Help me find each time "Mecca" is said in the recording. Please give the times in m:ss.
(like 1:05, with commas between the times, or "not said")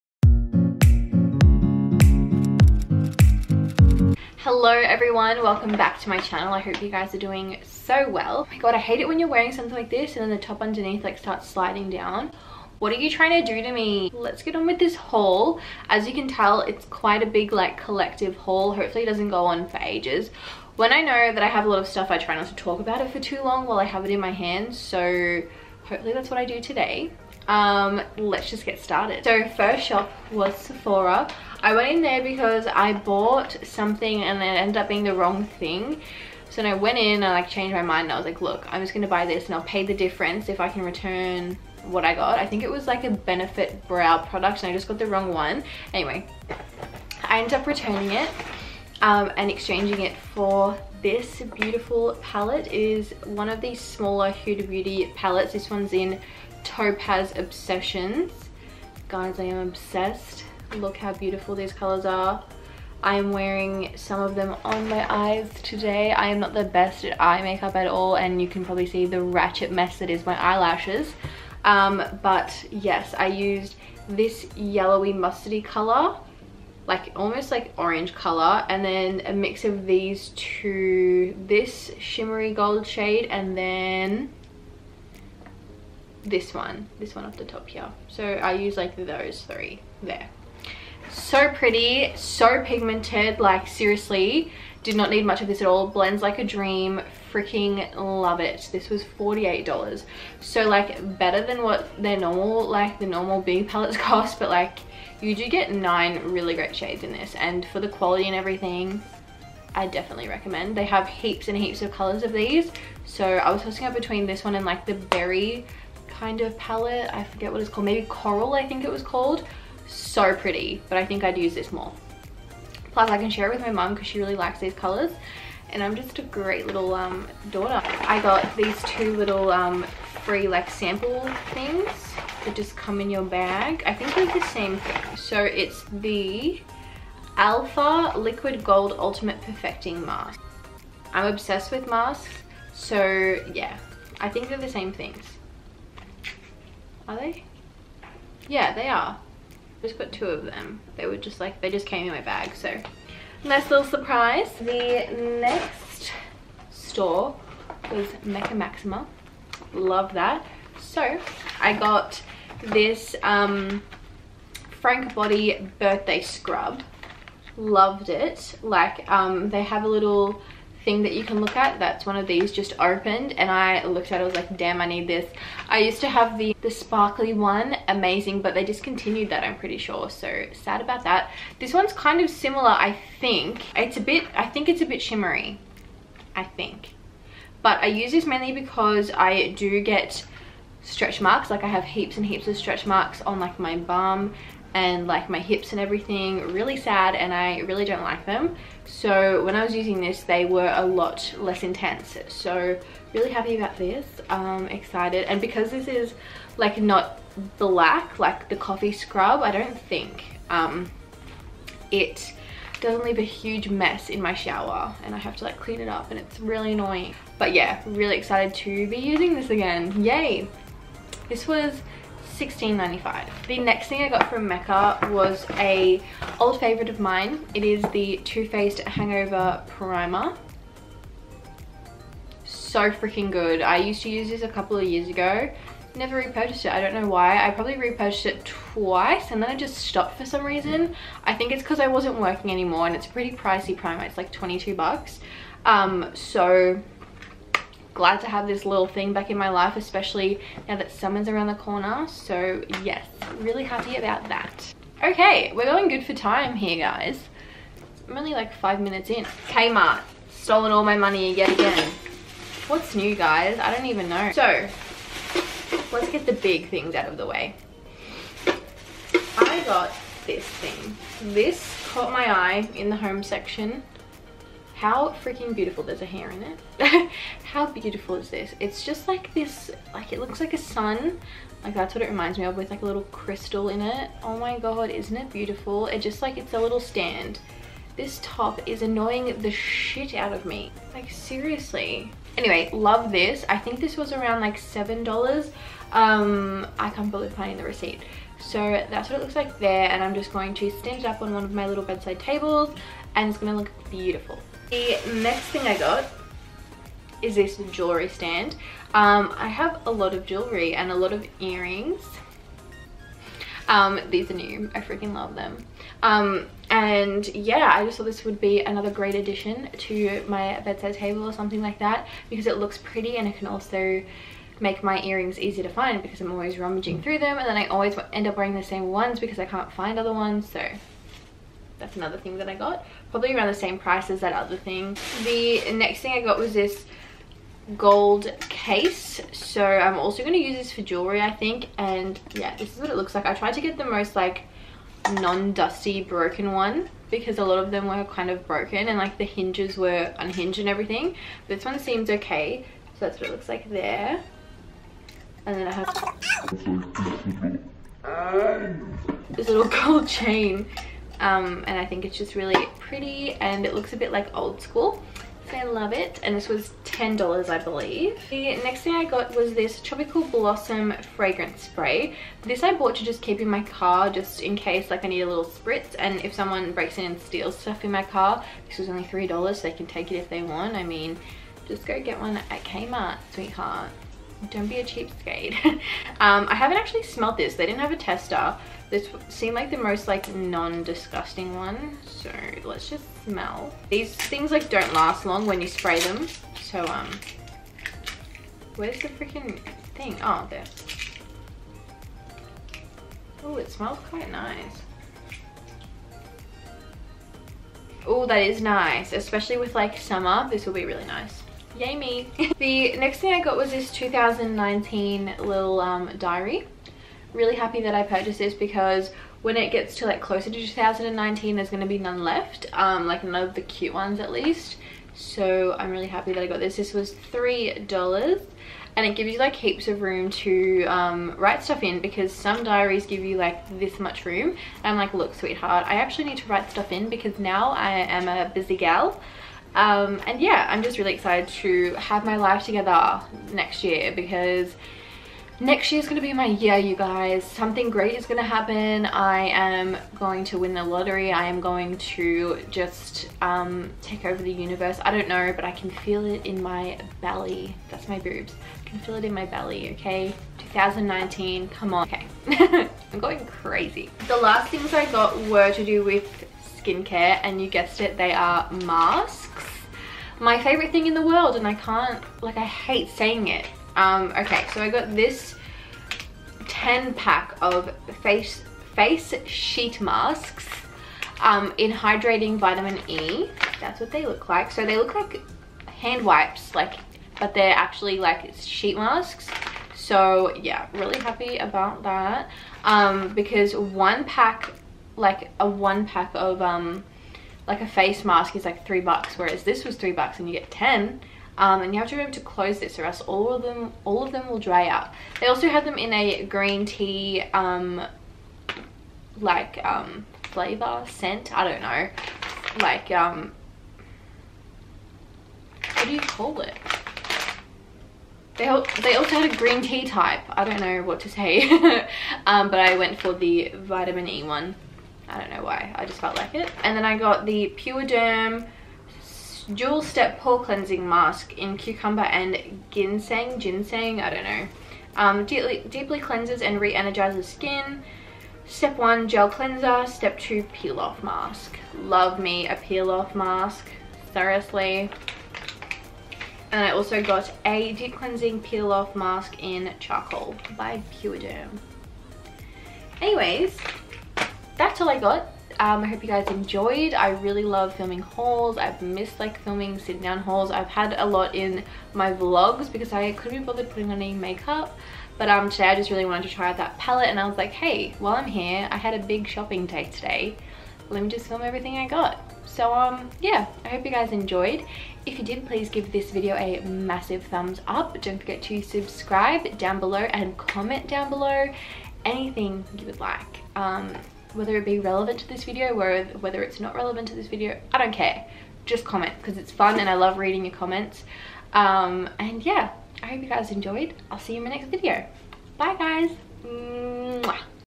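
2:38, 3:44.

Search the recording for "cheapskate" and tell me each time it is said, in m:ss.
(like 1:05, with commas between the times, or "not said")
6:24.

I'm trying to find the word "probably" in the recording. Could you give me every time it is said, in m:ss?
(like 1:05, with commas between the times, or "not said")
1:08, 3:57, 5:33.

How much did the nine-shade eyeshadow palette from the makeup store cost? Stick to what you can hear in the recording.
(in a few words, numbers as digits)
$48.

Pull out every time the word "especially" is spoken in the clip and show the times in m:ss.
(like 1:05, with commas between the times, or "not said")
4:09, 6:49.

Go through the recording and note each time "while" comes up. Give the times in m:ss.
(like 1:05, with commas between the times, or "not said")
0:23, 9:28.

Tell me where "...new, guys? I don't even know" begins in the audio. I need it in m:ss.
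4:22.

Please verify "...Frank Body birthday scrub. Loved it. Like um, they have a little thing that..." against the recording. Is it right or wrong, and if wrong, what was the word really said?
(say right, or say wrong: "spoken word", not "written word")
right.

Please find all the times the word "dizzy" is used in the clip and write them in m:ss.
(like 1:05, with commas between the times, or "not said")
not said.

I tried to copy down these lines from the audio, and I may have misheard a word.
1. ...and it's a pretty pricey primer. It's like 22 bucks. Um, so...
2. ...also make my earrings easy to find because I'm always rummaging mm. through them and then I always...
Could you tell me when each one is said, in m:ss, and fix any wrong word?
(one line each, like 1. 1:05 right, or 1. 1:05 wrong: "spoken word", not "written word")
1. 4:02 right
2. 5:23 right.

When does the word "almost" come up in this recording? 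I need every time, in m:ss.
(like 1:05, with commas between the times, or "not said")
1:17.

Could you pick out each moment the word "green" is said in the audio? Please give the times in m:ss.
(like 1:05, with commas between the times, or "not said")
8:26, 8:39.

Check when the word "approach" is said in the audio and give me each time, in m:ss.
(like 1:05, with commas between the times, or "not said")
not said.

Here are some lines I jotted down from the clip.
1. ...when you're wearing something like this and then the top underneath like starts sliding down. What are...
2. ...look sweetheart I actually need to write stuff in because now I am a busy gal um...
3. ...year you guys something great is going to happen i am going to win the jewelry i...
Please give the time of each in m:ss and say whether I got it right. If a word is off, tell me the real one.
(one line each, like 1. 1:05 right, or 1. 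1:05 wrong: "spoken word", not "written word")
1. 0:09 right
2. 7:15 right
3. 7:26 wrong: "lottery", not "jewelry".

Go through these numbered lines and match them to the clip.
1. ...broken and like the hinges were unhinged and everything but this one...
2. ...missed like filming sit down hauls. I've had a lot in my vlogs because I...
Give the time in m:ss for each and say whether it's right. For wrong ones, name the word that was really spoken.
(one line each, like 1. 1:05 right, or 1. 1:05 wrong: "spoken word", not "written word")
1. 5:48 right
2. 9:18 right.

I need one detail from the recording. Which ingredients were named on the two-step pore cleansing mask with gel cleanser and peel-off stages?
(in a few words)
Cucumber and Ginseng.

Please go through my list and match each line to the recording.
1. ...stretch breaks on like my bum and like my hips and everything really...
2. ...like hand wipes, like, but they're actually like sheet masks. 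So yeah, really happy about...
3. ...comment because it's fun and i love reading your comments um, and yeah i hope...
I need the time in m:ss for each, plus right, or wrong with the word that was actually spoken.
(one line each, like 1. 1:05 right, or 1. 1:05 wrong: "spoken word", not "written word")
1. 3:12 wrong: "marks", not "breaks"
2. 8:05 right
3. 9:49 right.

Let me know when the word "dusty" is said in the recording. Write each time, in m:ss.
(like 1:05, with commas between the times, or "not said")
5:45.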